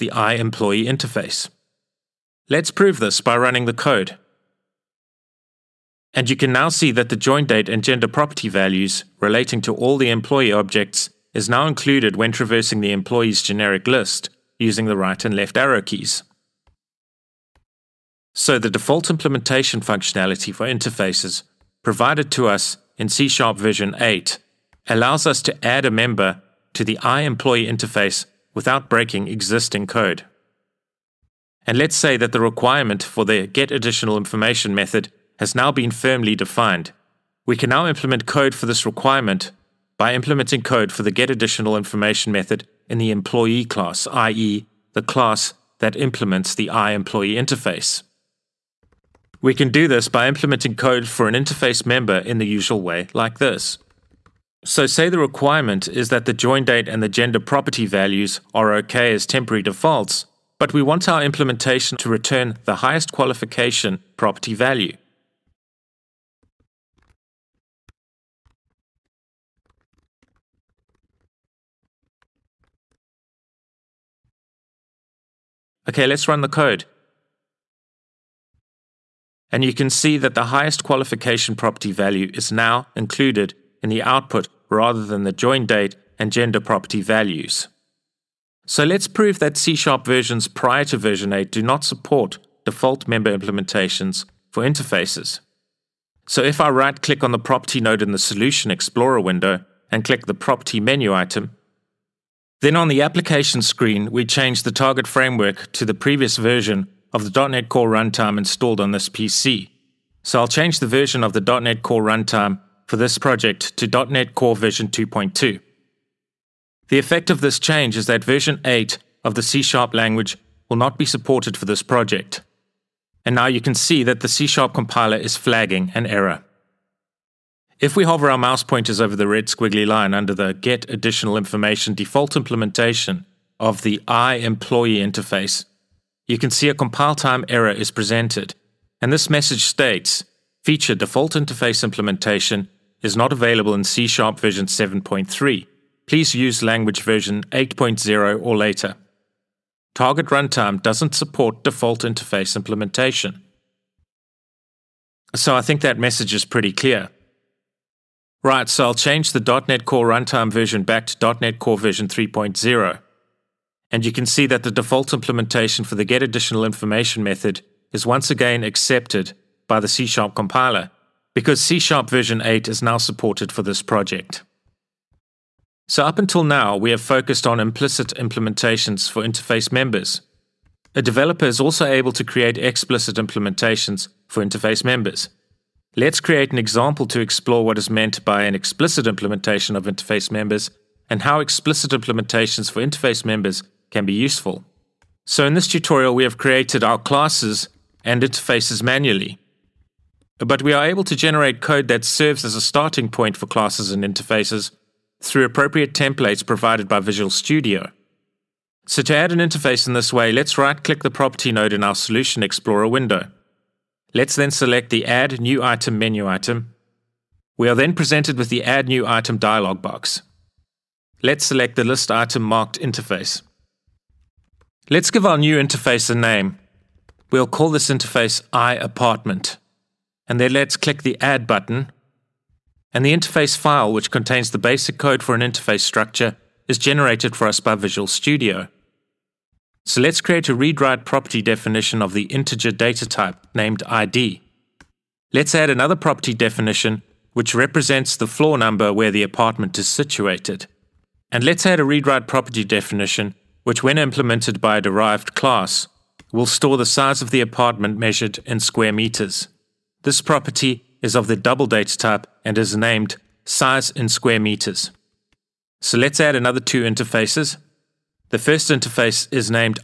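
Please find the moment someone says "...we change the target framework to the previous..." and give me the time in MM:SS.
01:44.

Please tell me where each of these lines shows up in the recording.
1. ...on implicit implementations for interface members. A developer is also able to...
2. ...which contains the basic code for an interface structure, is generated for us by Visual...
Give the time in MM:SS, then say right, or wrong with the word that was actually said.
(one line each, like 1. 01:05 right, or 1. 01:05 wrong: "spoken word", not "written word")
1. 02:57 right
2. 03:53 right.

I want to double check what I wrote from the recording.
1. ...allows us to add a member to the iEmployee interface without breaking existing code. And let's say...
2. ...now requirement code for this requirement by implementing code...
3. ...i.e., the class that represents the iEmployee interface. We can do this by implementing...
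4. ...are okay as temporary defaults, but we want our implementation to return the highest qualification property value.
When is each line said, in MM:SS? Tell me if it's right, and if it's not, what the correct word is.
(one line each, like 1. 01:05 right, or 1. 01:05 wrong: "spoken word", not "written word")
1. 00:24 right
2. 00:37 wrong: "implement", not "requirement"
3. 00:44 wrong: "implements", not "represents"
4. 00:58 right.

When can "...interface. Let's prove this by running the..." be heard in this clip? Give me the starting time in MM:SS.
00:00.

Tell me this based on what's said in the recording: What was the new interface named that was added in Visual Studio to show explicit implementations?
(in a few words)
IApartment.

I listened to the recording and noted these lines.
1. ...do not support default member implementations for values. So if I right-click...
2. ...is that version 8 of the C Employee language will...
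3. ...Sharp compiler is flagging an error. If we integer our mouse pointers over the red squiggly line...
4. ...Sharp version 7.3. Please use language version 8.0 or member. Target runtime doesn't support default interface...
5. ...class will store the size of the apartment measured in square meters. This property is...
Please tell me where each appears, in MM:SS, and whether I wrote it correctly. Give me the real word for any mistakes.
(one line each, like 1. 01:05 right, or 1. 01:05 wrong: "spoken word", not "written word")
1. 01:31 wrong: "interfaces", not "values"
2. 01:57 wrong: "Sharp", not "Employee"
3. 02:04 wrong: "hover", not "integer"
4. 02:24 wrong: "later", not "member"
5. 04:15 right.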